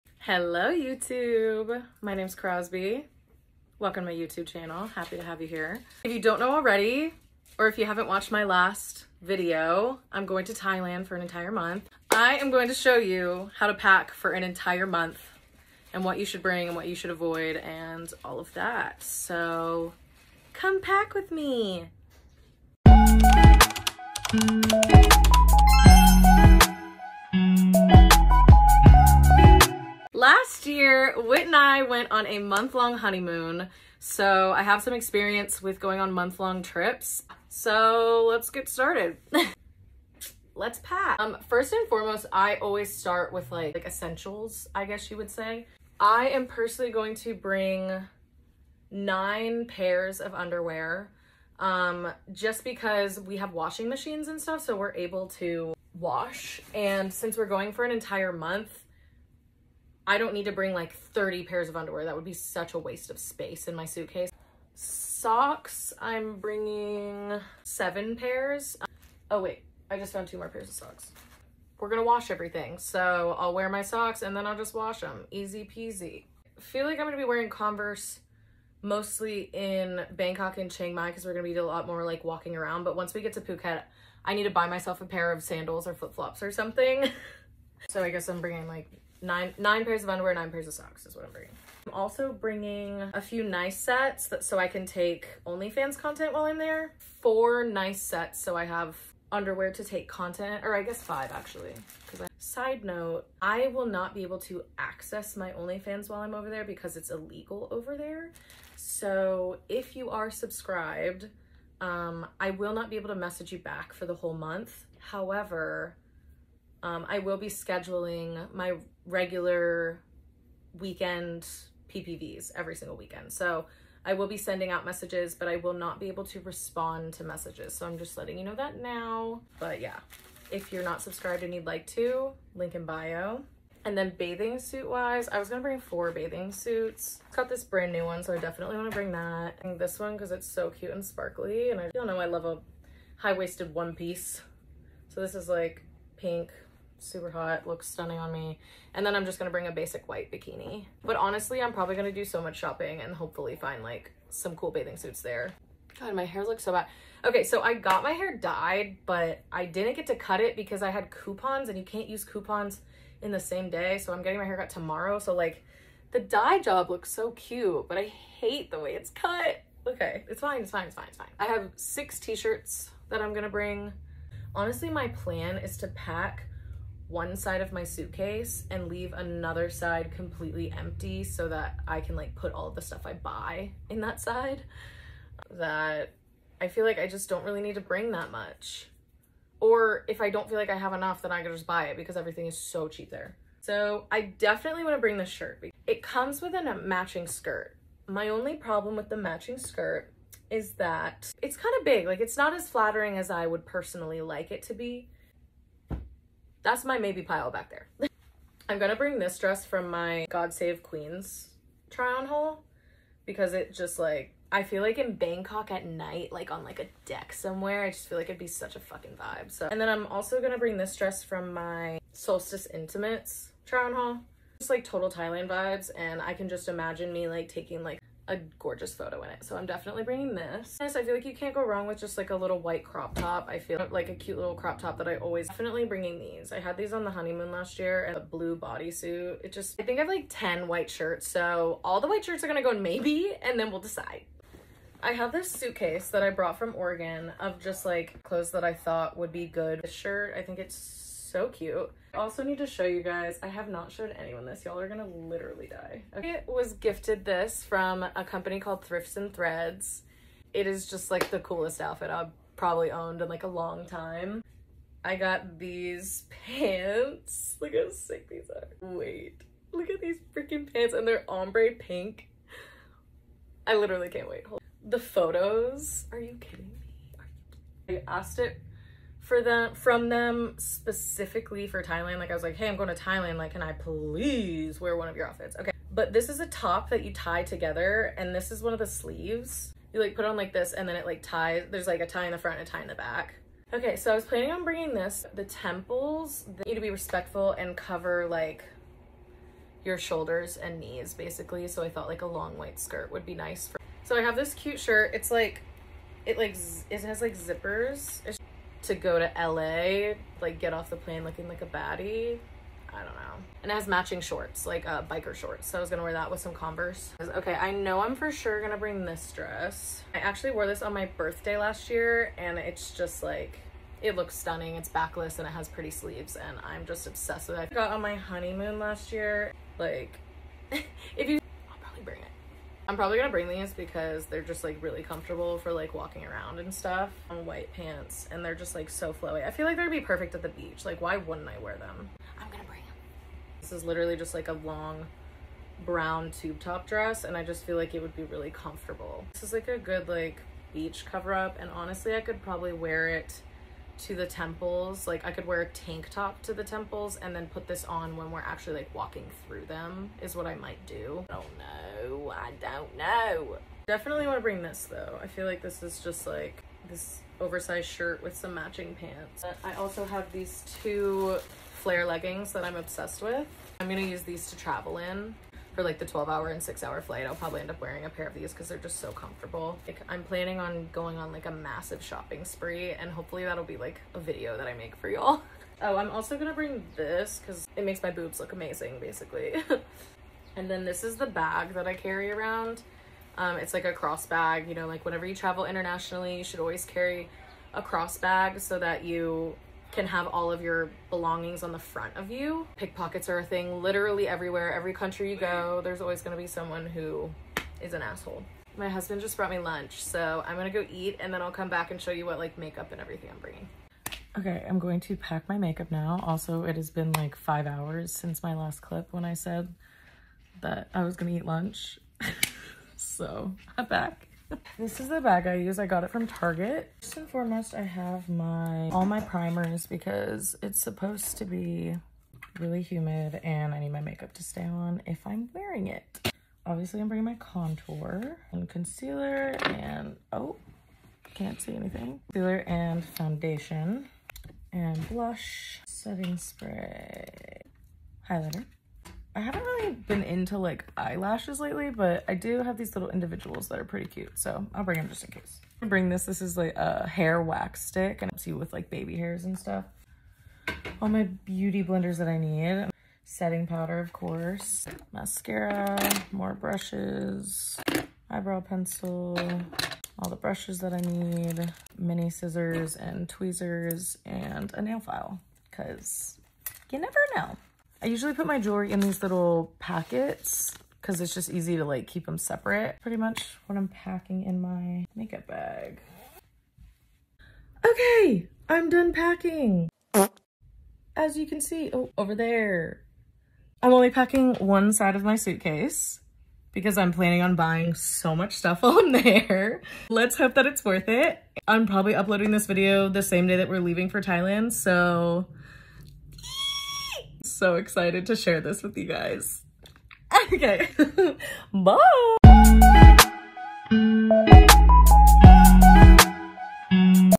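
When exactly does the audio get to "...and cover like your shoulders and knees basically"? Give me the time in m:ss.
4:57.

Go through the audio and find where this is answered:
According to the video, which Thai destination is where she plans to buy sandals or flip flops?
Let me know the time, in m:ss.
1:23.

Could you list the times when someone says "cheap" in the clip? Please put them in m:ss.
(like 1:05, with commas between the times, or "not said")
3:12.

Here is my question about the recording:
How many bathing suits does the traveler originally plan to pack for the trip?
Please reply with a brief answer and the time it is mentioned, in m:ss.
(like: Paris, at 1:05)
4, at 2:15.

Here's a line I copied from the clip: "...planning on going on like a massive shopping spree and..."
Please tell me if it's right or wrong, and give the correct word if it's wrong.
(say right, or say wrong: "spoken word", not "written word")
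right.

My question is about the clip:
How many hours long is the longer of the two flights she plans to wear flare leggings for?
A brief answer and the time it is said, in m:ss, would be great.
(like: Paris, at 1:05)
12, at 6:16.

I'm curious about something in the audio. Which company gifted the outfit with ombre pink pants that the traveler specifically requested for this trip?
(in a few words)
Thrifts and Threads.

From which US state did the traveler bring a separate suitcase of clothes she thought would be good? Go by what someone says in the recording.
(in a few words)
Oregon.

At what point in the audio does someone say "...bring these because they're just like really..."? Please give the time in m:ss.
5:33.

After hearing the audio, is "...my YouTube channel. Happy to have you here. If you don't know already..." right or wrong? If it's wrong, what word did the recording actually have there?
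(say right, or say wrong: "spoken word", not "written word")
right.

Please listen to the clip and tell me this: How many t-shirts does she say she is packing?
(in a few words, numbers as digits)
6.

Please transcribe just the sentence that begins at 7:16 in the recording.
Obviously, I'm bringing my contour and concealer and, oh, can't see anything.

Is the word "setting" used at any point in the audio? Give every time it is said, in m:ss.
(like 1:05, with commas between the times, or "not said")
7:25, 7:43.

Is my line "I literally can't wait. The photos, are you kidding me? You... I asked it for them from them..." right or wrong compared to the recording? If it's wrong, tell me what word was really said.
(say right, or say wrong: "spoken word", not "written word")
right.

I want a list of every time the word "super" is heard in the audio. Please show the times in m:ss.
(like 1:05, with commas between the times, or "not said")
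2:27.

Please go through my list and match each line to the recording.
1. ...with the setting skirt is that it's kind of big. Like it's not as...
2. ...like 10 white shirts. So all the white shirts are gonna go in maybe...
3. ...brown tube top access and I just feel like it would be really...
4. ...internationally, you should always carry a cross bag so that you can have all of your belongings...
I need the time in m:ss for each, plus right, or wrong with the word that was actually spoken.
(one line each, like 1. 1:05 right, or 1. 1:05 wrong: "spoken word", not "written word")
1. 3:18 wrong: "matching", not "setting"
2. 4:00 right
3. 5:45 wrong: "dress", not "access"
4. 6:35 right.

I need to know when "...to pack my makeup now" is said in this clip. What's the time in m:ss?
6:55.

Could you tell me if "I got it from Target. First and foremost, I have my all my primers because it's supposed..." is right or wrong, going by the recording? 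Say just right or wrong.
right.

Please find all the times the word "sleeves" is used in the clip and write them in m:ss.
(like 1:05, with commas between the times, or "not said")
4:48, 5:25.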